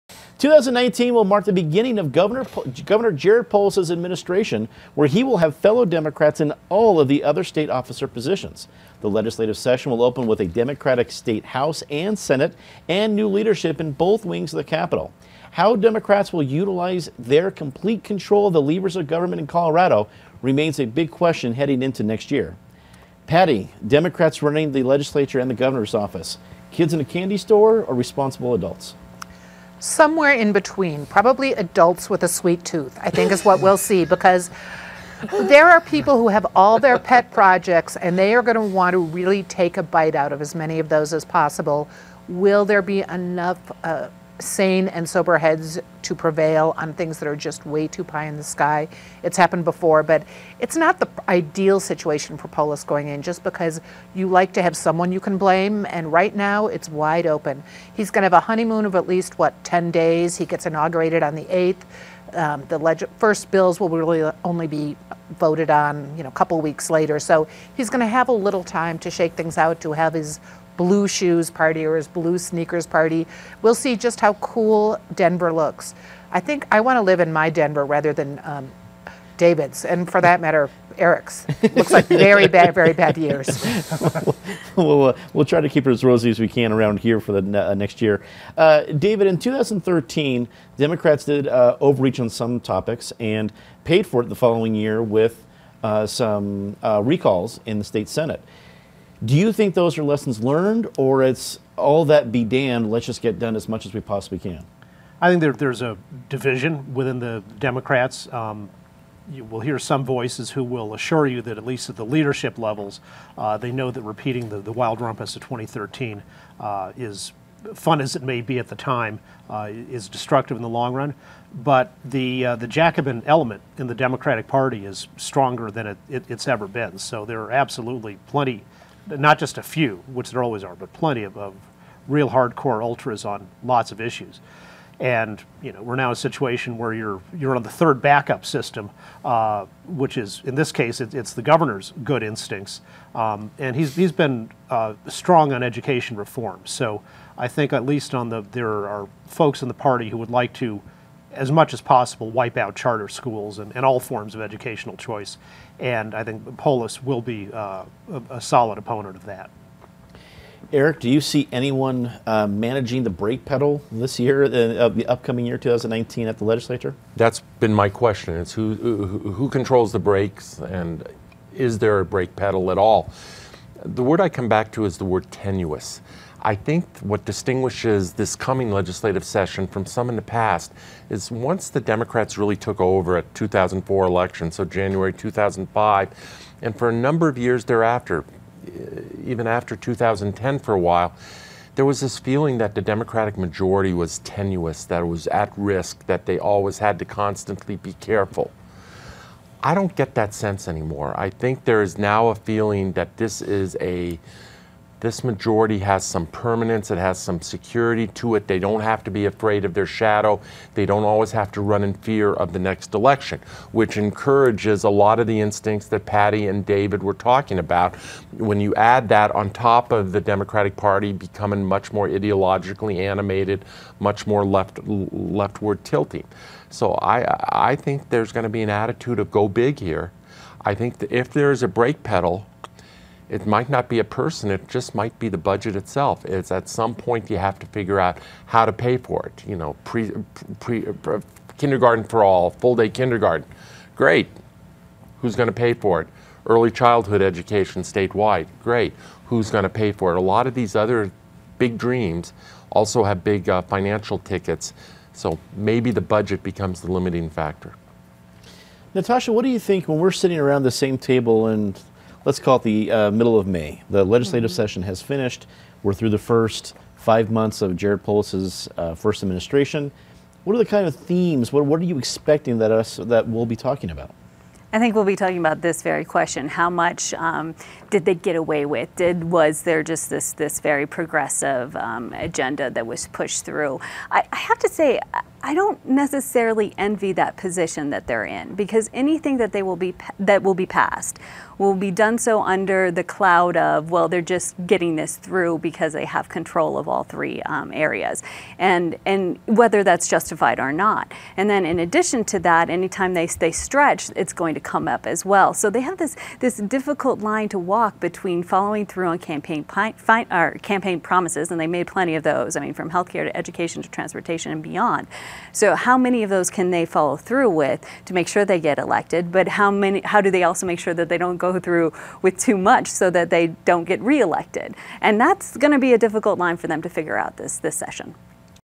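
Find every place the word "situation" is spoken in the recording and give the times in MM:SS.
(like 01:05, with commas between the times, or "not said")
00:51, 02:16.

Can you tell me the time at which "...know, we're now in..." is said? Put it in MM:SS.
02:15.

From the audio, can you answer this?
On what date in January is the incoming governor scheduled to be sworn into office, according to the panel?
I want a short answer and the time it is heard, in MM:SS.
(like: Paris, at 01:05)
the 8th, at 01:01.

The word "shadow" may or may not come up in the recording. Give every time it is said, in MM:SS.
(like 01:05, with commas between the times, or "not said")
03:29.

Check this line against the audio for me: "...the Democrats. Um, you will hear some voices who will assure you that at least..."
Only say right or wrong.
right.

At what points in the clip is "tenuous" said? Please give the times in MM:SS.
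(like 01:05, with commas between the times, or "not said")
02:55, 03:14.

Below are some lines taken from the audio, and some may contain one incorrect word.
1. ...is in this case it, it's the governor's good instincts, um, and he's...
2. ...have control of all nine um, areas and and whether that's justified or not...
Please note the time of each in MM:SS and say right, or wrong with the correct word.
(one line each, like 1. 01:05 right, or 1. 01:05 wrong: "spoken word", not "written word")
1. 02:20 right
2. 04:56 wrong: "three", not "nine".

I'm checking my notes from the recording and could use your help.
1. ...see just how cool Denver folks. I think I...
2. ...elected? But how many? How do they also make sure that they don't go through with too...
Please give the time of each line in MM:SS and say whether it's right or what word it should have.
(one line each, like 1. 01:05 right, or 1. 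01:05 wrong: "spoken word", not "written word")
1. 01:13 wrong: "looks", not "folks"
2. 05:18 right.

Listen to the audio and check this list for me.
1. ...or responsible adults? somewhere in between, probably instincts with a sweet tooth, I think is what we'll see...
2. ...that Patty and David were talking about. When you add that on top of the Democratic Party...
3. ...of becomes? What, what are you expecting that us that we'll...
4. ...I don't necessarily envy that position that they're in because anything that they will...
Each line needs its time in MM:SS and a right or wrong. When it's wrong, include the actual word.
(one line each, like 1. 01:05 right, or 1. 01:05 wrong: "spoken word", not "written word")
1. 00:27 wrong: "adults", not "instincts"
2. 03:35 right
3. 04:30 wrong: "themes", not "becomes"
4. 04:45 right.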